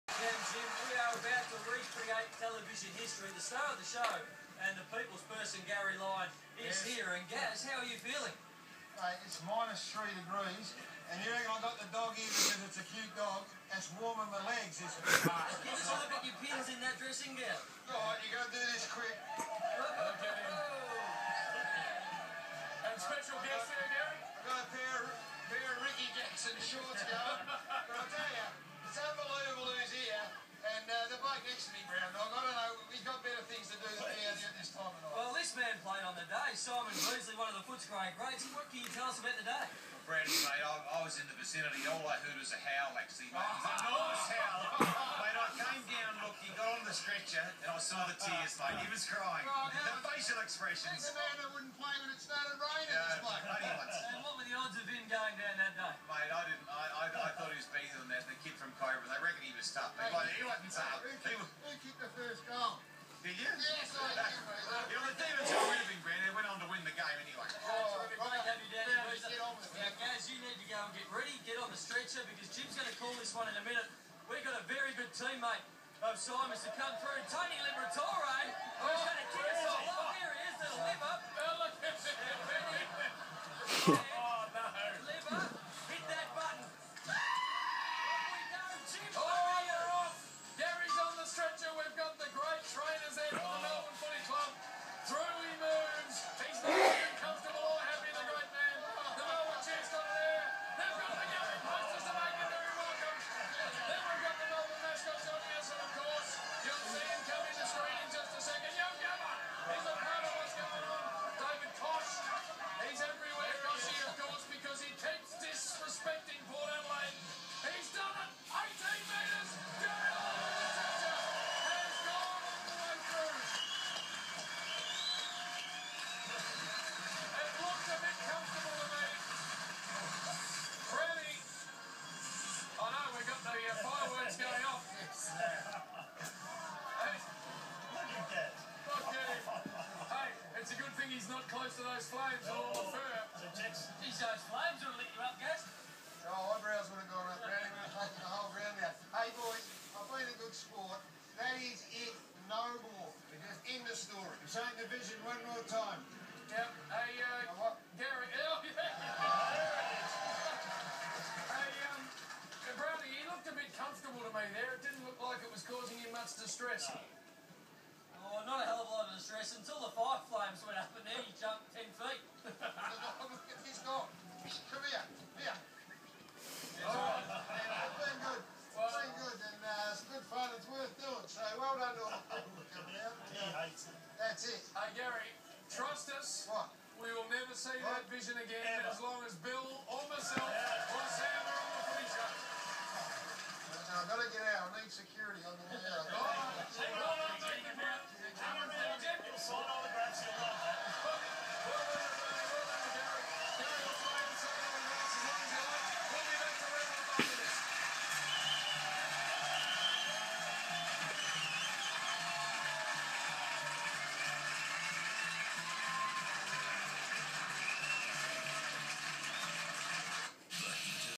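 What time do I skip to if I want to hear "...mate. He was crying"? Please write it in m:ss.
0:48.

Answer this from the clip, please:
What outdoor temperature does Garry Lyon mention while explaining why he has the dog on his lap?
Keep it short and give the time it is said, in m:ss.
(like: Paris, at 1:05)
-3 degrees, at 0:09.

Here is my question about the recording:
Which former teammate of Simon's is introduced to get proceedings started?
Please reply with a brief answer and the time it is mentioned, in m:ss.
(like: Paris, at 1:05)
Tony Liberatore, at 1:17.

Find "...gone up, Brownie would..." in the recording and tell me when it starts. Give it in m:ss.
2:27.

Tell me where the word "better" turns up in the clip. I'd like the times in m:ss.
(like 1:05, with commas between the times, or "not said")
0:57.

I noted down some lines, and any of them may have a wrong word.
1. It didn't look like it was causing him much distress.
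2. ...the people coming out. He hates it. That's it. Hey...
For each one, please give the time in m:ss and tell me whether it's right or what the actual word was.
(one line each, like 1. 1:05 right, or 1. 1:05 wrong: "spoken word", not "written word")
1. 2:44 right
2. 3:02 right.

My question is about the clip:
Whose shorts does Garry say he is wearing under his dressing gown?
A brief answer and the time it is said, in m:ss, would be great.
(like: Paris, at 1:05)
Ricky Jackson, at 0:25.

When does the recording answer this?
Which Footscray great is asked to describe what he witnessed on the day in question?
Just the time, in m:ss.
0:36.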